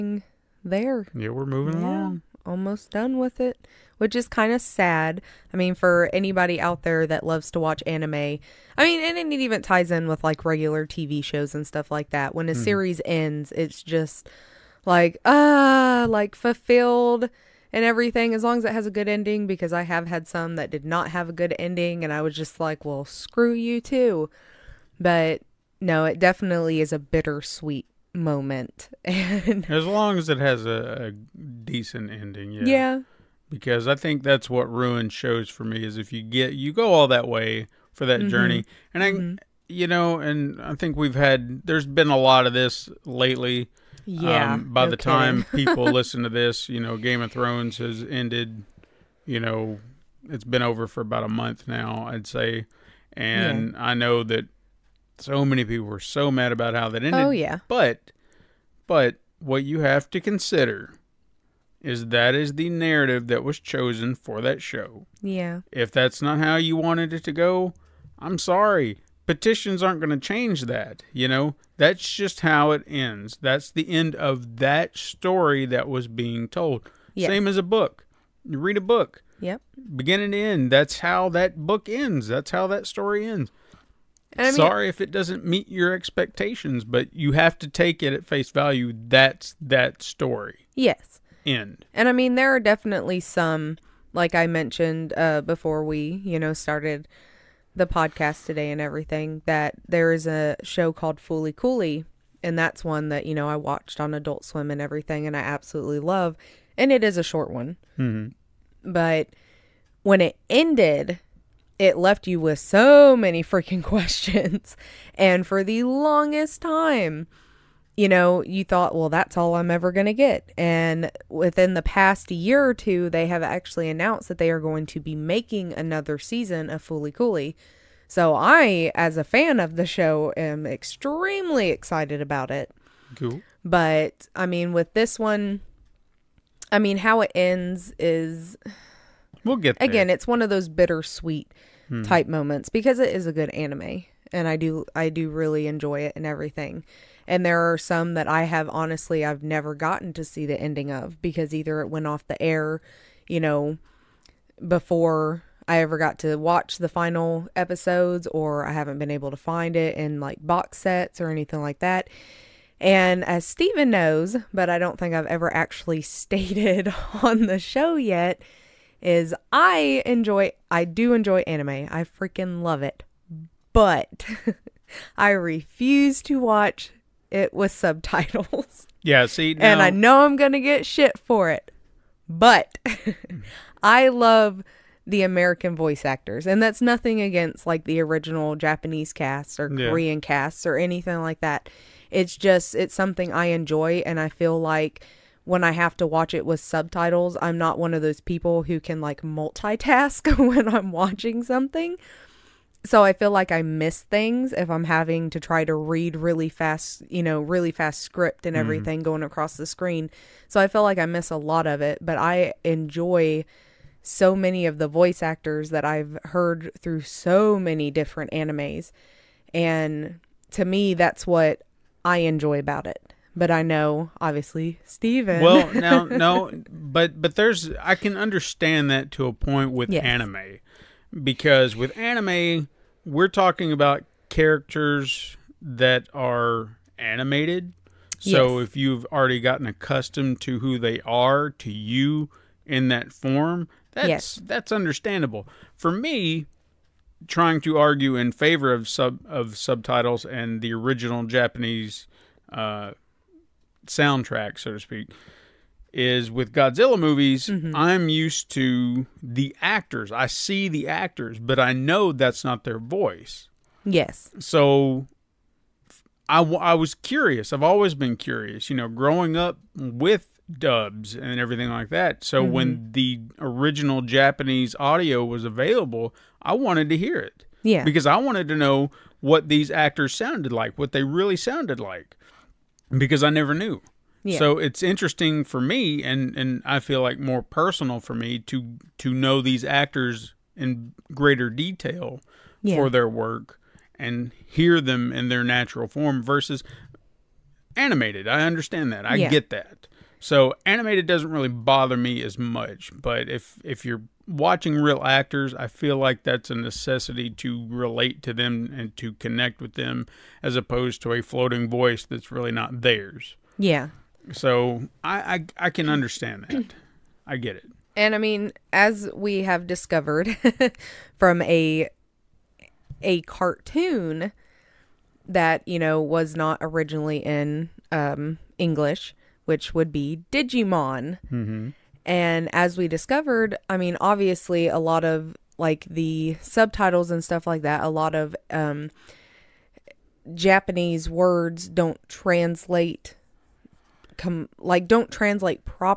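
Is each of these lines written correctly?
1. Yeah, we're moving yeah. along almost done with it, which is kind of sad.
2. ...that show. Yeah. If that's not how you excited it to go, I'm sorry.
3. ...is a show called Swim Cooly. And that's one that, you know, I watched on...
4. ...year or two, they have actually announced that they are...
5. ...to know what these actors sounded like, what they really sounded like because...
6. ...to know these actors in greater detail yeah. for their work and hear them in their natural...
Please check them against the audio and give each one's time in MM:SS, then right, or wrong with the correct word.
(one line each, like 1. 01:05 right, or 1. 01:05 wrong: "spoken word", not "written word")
1. 00:01 right
2. 01:04 wrong: "wanted", not "excited"
3. 01:40 wrong: "Fooly", not "Swim"
4. 02:02 right
5. 04:38 right
6. 04:48 right.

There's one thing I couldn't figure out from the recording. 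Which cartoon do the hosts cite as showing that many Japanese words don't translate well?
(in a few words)
Digimon.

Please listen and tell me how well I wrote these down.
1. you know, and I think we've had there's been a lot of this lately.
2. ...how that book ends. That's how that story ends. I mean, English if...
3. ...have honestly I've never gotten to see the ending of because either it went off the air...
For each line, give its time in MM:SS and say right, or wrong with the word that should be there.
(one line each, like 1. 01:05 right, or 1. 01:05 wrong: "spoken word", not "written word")
1. 00:39 right
2. 01:21 wrong: "Sorry", not "English"
3. 02:28 right.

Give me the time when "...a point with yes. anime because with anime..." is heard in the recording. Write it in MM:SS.
03:49.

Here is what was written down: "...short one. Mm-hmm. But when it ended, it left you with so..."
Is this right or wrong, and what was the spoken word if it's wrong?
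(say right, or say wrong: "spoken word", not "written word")
right.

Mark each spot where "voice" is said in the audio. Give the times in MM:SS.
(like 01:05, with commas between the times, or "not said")
03:05, 03:34, 04:22, 05:11.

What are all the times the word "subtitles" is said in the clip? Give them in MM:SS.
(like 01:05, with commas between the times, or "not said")
02:57, 03:16, 04:09, 05:36.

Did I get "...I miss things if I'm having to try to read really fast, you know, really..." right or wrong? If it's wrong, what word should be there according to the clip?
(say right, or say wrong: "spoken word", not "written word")
right.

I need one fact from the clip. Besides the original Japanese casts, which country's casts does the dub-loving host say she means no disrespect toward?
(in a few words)
Korean.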